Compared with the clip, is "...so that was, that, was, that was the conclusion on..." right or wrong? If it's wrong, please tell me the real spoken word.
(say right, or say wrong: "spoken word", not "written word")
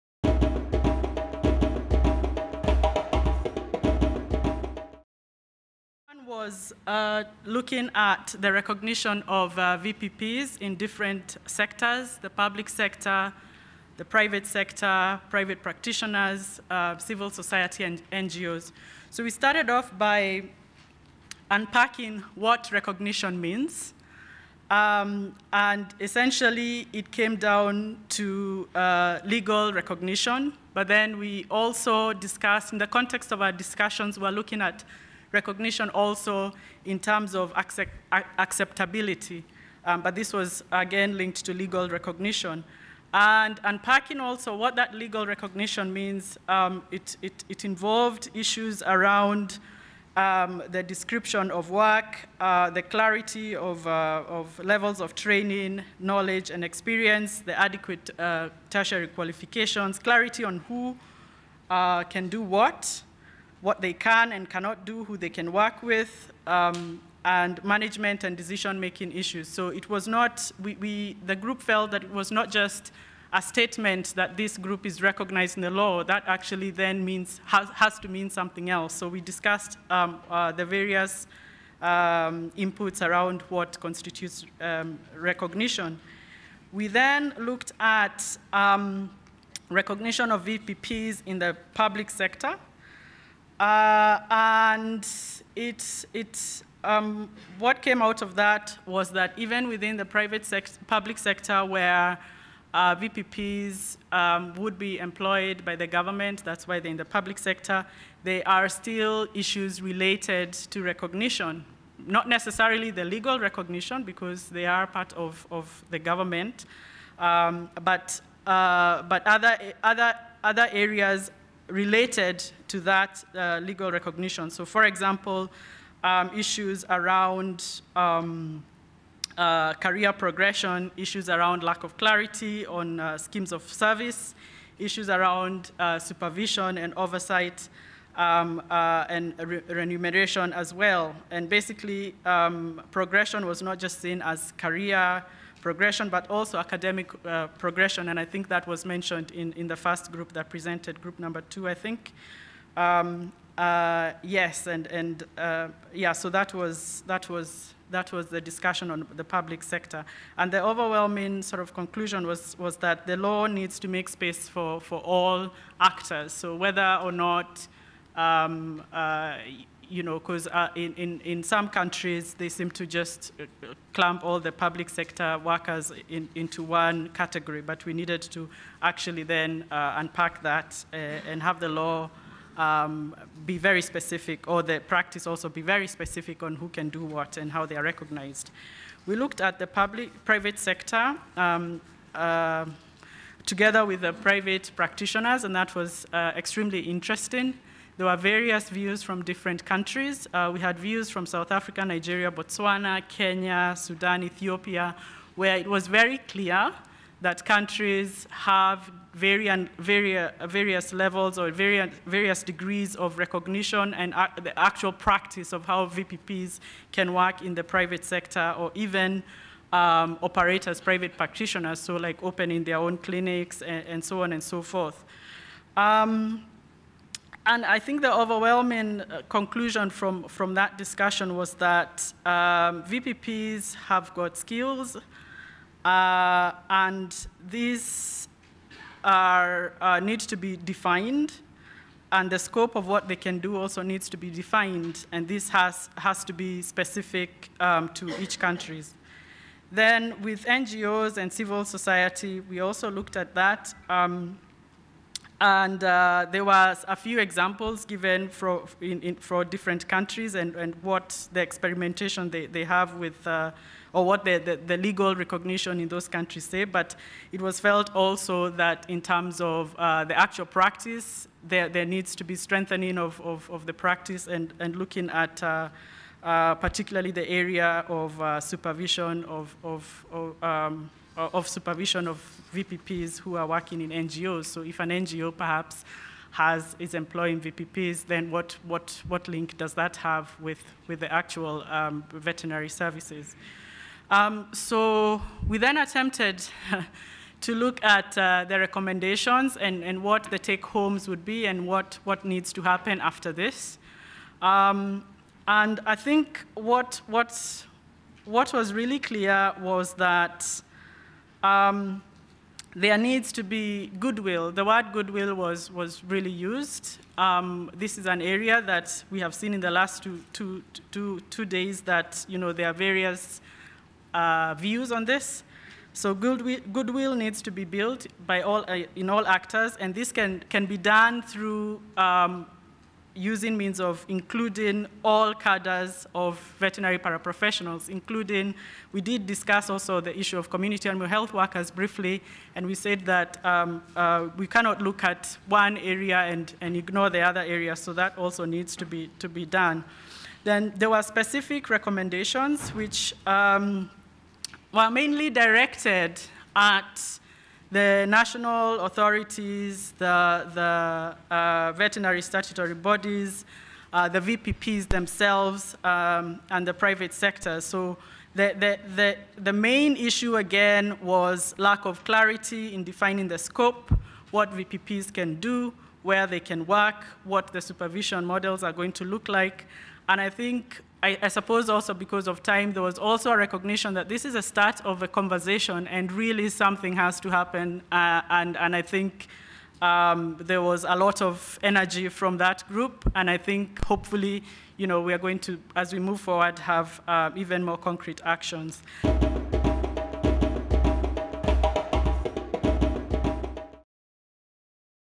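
wrong: "discussion", not "conclusion".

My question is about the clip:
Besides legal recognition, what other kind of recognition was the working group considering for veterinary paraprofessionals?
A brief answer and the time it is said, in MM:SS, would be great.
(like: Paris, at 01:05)
Acceptability, at 00:38.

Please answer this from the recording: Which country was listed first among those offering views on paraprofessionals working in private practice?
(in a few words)
South Africa.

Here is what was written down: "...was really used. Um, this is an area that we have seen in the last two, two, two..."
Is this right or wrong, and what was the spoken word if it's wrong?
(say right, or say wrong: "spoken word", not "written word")
right.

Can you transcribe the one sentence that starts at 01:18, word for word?
So we discussed um, uh, the various um, inputs around what constitutes um, recognition.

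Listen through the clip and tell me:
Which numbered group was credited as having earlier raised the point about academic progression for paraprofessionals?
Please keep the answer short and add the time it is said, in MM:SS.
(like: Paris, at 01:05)
Group number two, at 02:31.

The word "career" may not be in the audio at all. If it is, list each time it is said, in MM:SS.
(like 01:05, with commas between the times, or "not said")
02:09, 02:24.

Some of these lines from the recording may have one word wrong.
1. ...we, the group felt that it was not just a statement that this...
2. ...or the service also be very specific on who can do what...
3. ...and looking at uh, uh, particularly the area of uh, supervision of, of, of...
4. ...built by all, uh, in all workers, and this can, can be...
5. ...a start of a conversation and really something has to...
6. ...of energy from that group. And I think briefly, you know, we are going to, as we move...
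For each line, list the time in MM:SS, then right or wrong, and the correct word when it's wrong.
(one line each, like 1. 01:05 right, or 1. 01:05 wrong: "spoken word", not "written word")
1. 01:10 right
2. 03:04 wrong: "practice", not "service"
3. 04:34 right
4. 05:27 wrong: "actors", not "workers"
5. 06:24 right
6. 06:31 wrong: "hopefully", not "briefly".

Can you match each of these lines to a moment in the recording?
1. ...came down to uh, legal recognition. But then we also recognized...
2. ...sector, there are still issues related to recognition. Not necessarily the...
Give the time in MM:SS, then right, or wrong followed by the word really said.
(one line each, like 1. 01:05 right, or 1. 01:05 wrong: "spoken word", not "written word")
1. 00:27 wrong: "discussed", not "recognized"
2. 01:47 right.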